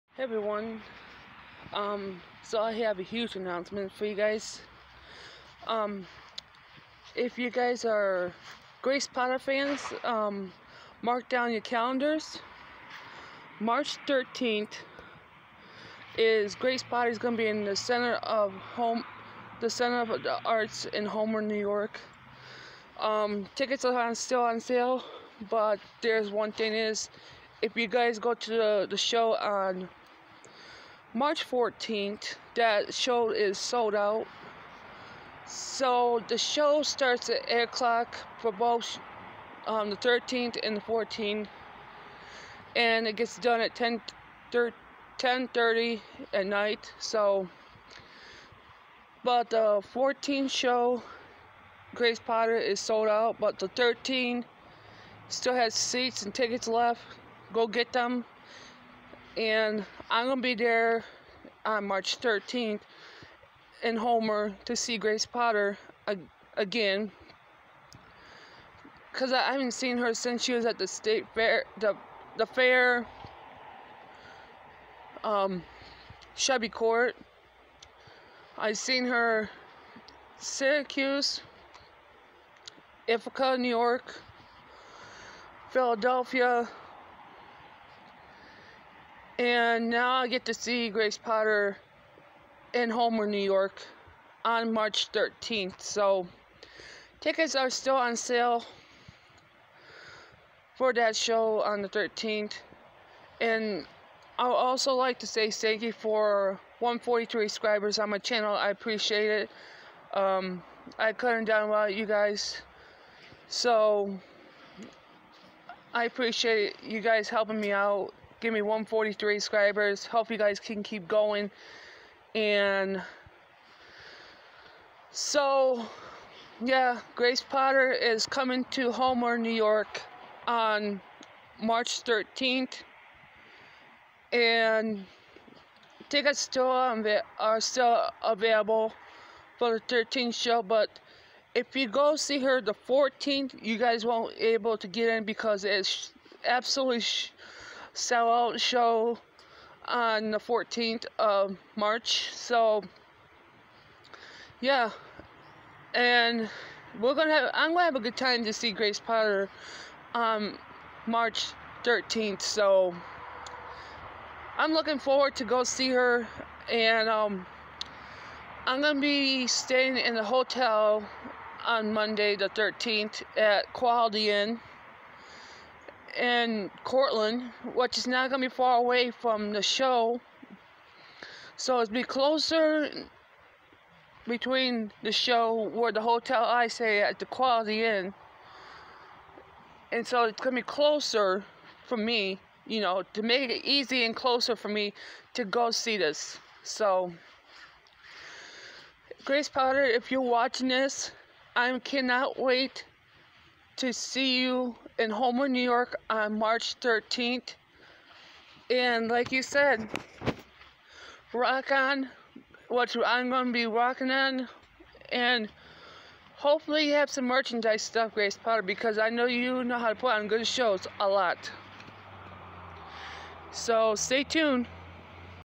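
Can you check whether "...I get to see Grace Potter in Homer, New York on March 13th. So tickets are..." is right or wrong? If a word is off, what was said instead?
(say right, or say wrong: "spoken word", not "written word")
right.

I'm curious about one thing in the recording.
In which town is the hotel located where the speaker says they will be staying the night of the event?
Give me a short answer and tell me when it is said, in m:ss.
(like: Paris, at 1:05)
Cortland, at 2:56.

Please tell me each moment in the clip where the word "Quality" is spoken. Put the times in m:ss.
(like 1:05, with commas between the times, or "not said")
2:53, 3:07.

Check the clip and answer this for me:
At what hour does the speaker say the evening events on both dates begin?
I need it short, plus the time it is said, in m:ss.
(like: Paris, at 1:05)
8 o'clock, at 0:37.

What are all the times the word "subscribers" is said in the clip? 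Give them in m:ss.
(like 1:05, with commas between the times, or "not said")
1:47, 1:59.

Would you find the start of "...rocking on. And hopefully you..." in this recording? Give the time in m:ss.
3:33.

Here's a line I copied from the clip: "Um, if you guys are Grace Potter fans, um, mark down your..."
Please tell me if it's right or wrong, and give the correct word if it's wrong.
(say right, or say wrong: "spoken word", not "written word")
right.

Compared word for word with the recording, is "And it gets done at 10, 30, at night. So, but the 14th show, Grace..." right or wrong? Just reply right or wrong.
right.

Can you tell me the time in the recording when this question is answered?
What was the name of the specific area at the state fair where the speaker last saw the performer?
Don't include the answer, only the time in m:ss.
1:16.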